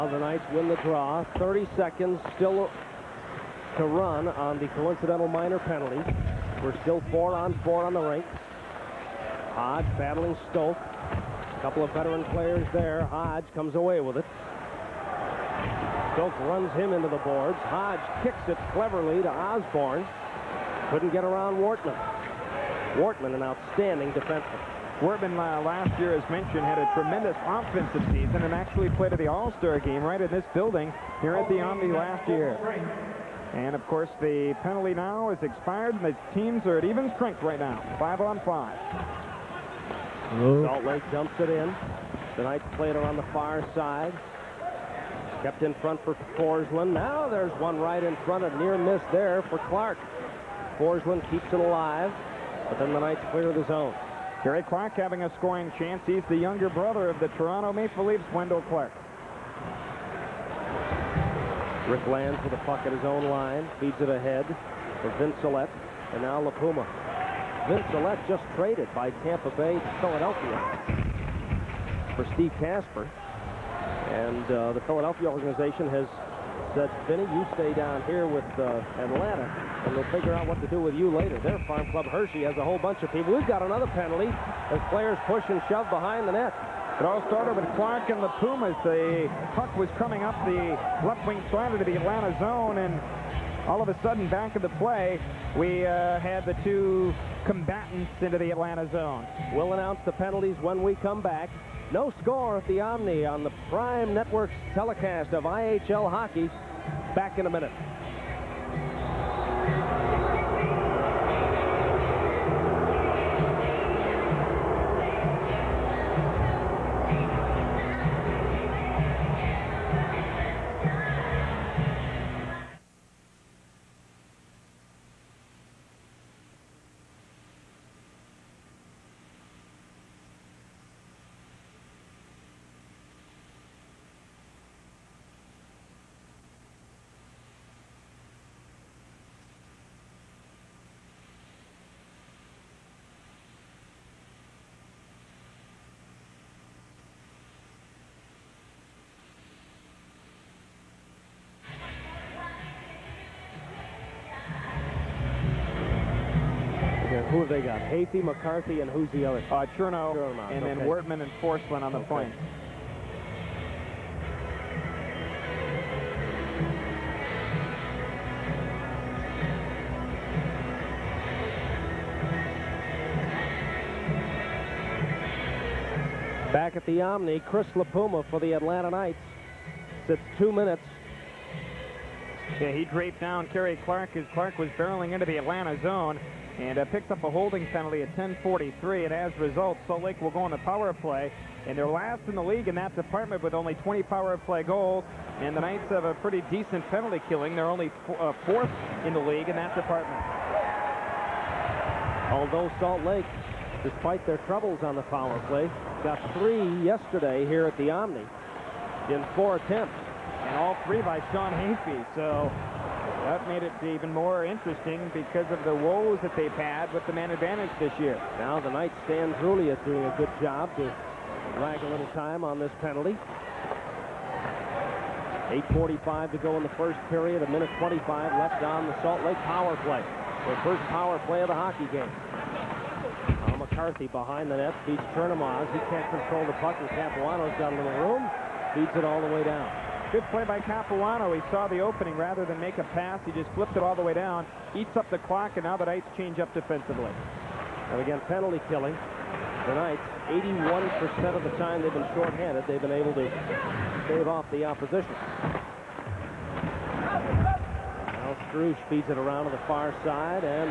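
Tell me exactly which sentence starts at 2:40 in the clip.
then Wortman and Forslund on the okay.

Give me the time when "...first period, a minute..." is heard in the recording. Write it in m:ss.
3:46.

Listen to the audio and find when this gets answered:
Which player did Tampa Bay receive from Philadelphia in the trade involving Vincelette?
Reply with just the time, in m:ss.
1:12.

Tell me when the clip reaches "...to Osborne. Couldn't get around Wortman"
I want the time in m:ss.
0:19.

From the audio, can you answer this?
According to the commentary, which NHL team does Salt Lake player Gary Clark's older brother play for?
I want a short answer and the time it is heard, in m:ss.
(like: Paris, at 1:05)
Toronto Maple Leafs, at 0:57.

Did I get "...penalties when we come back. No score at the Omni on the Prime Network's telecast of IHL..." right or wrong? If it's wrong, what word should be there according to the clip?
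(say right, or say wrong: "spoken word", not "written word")
right.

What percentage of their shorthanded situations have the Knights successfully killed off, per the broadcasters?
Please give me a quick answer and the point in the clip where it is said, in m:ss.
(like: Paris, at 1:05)
81%, at 4:10.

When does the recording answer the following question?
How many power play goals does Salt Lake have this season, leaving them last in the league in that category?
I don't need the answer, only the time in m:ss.
3:13.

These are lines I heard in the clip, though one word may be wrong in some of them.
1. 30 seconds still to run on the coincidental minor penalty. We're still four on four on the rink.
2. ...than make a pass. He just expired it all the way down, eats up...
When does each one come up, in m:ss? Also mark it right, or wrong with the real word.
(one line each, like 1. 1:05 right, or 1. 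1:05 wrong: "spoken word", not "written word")
1. 0:01 right
2. 4:02 wrong: "flipped", not "expired".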